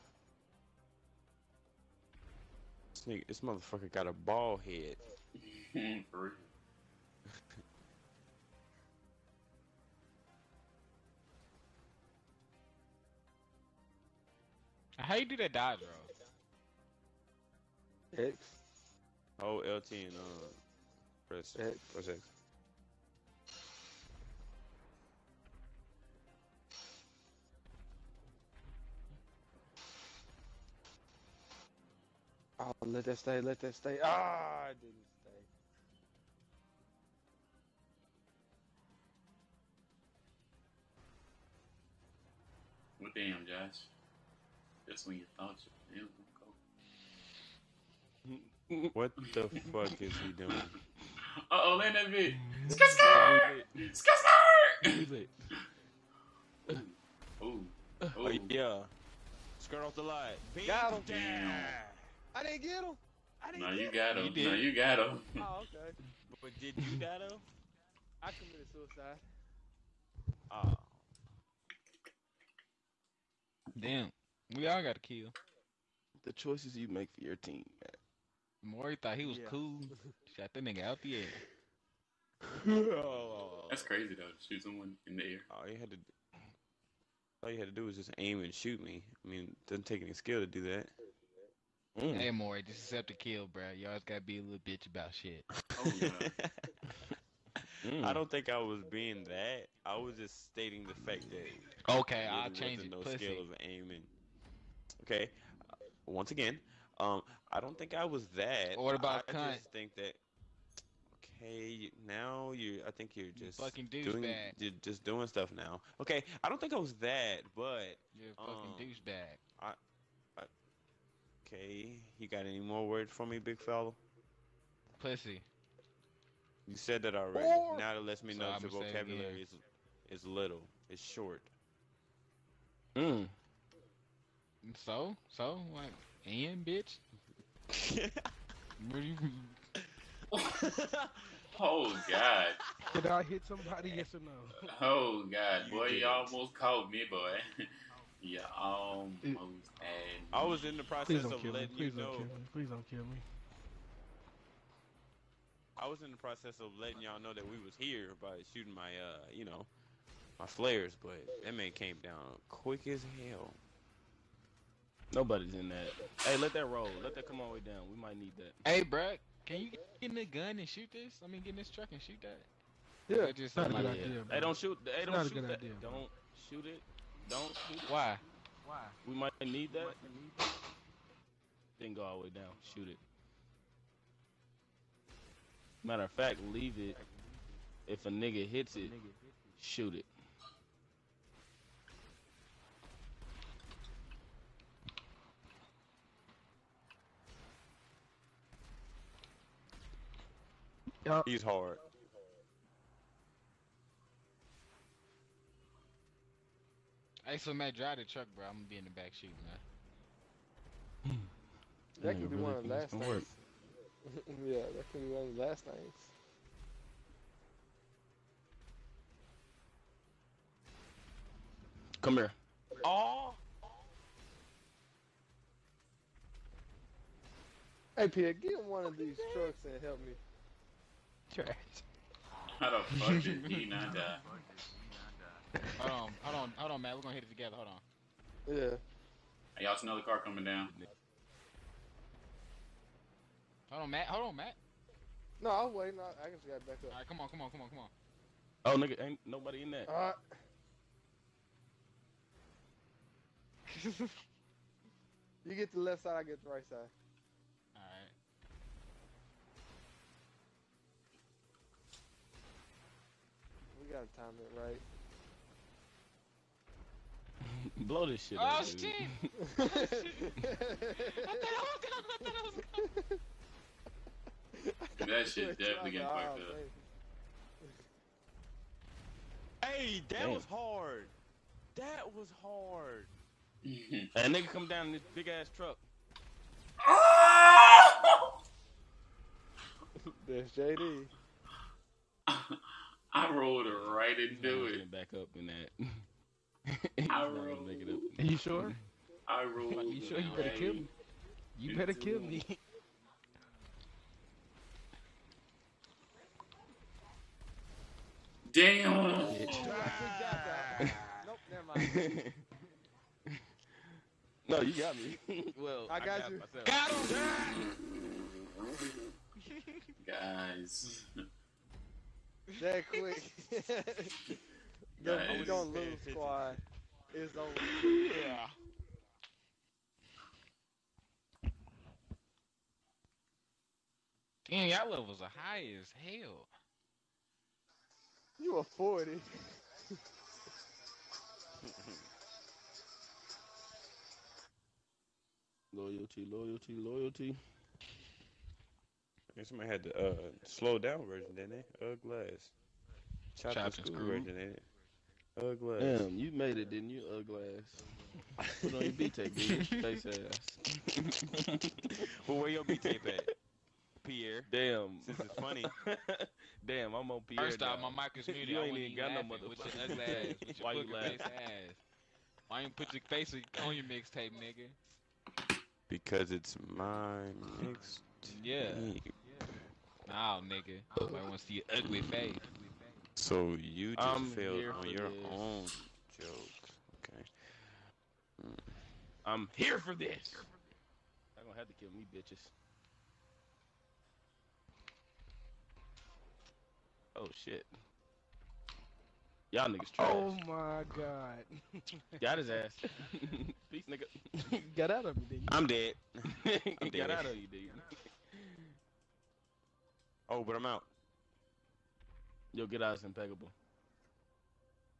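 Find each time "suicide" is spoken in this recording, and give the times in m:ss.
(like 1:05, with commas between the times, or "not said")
1:08.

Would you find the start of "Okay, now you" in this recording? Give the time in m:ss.
1:51.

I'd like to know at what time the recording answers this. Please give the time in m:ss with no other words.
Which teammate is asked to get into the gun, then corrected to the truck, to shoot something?
2:48.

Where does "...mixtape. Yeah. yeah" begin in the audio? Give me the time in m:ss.
6:17.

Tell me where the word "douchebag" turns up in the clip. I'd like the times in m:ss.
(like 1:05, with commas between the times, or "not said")
1:58.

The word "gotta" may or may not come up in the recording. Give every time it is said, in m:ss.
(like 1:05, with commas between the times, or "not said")
1:34, 4:23.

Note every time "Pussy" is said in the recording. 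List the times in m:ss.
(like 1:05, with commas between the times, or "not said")
1:42, 2:04.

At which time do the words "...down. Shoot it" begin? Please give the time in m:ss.
3:02.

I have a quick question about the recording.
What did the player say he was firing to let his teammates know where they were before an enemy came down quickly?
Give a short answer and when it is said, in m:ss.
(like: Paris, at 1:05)
Flares, at 2:40.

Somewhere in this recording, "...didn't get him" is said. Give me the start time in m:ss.
1:02.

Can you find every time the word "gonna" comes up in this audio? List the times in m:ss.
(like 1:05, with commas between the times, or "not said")
3:28, 3:57, 6:31.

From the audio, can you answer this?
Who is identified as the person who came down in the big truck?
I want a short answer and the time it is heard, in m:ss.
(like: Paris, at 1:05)
JD, at 4:50.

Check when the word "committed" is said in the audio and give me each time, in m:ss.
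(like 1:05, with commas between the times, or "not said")
1:08.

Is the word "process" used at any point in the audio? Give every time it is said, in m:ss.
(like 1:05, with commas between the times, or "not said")
2:30, 2:36.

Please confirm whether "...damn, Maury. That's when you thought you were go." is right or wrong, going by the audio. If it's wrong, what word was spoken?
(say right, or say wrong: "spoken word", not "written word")
wrong: "Josh", not "Maury".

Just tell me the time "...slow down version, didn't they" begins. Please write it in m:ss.
5:50.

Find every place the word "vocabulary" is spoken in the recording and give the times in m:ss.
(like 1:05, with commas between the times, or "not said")
2:08.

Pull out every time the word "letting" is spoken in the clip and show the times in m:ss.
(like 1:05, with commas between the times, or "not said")
2:31, 2:36.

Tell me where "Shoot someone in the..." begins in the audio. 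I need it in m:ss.
1:24.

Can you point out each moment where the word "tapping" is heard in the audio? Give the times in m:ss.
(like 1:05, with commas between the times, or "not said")
not said.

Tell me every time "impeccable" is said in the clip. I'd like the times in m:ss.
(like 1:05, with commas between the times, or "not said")
6:53.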